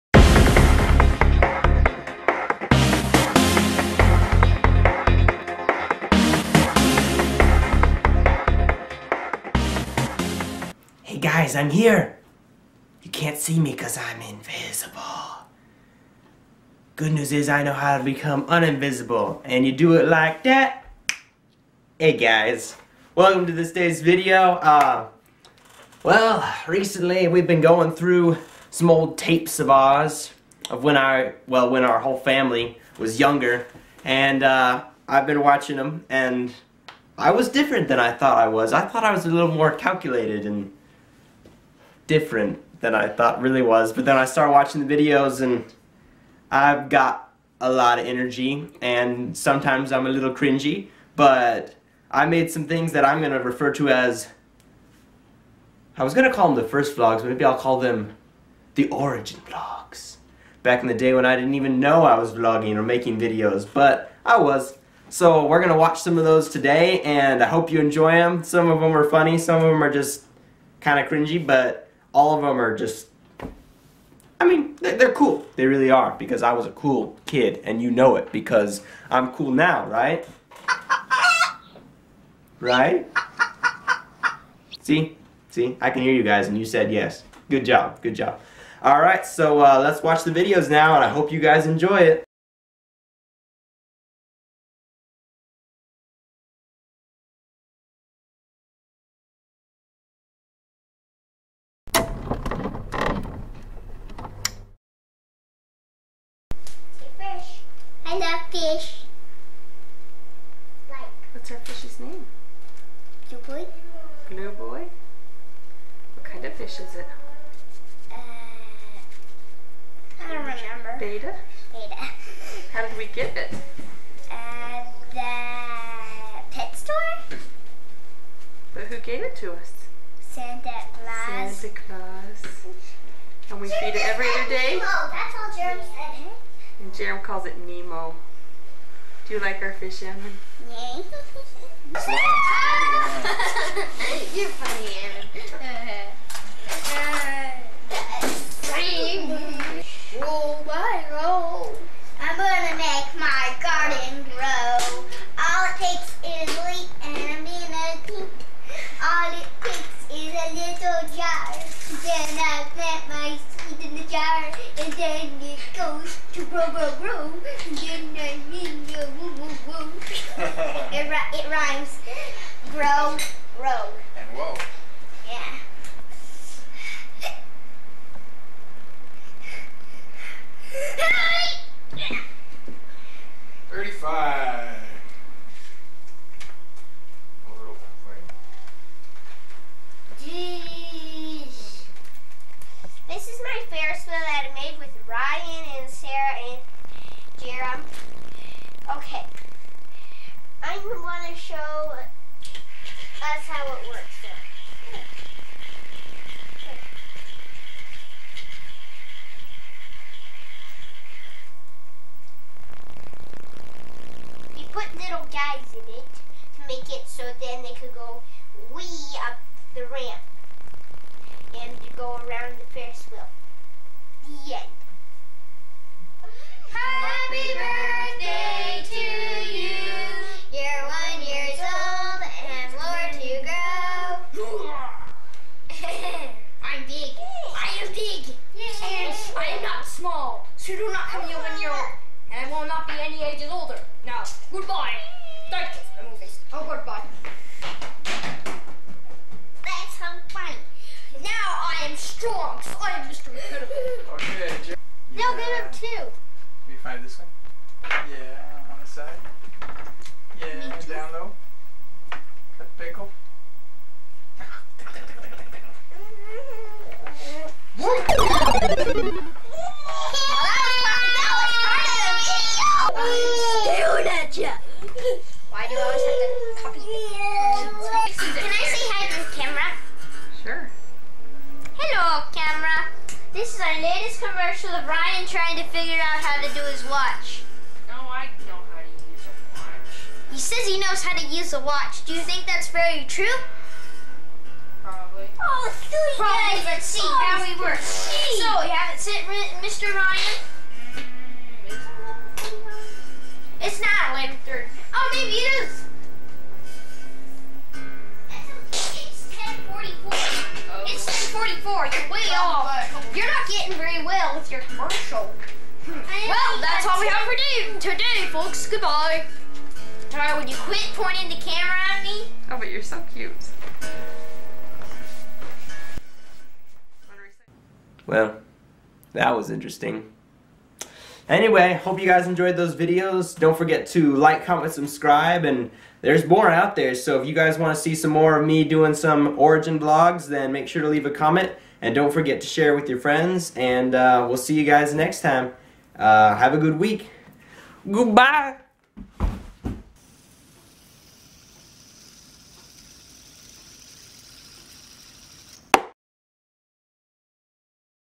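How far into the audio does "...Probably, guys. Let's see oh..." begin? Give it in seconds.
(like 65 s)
296 s.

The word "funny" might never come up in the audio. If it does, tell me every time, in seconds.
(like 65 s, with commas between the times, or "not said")
69 s, 144 s.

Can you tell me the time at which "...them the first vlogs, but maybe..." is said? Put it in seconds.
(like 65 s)
56 s.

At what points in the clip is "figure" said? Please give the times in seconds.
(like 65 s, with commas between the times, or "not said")
285 s.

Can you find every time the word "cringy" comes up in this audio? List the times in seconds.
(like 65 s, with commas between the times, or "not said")
50 s, 71 s.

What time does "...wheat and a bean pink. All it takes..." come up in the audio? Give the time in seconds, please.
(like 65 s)
156 s.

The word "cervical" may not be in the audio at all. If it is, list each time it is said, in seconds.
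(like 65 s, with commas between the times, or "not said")
not said.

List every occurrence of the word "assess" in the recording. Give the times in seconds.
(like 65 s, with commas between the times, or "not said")
not said.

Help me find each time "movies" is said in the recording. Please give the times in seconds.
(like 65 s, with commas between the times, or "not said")
246 s.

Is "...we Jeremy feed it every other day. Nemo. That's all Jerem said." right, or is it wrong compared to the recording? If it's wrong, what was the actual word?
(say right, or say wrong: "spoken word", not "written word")
right.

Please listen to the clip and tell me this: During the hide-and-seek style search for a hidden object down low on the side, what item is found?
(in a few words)
A pickle.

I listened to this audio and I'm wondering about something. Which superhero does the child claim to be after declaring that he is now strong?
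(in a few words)
Mr. Incredible.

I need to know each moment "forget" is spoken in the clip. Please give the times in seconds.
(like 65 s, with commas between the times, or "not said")
333 s, 342 s.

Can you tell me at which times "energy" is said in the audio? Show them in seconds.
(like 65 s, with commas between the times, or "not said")
48 s.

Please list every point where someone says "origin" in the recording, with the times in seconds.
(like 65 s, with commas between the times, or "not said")
58 s, 339 s.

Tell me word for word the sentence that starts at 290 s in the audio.
He says he knows how to use a watch.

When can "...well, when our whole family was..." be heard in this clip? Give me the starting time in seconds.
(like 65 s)
31 s.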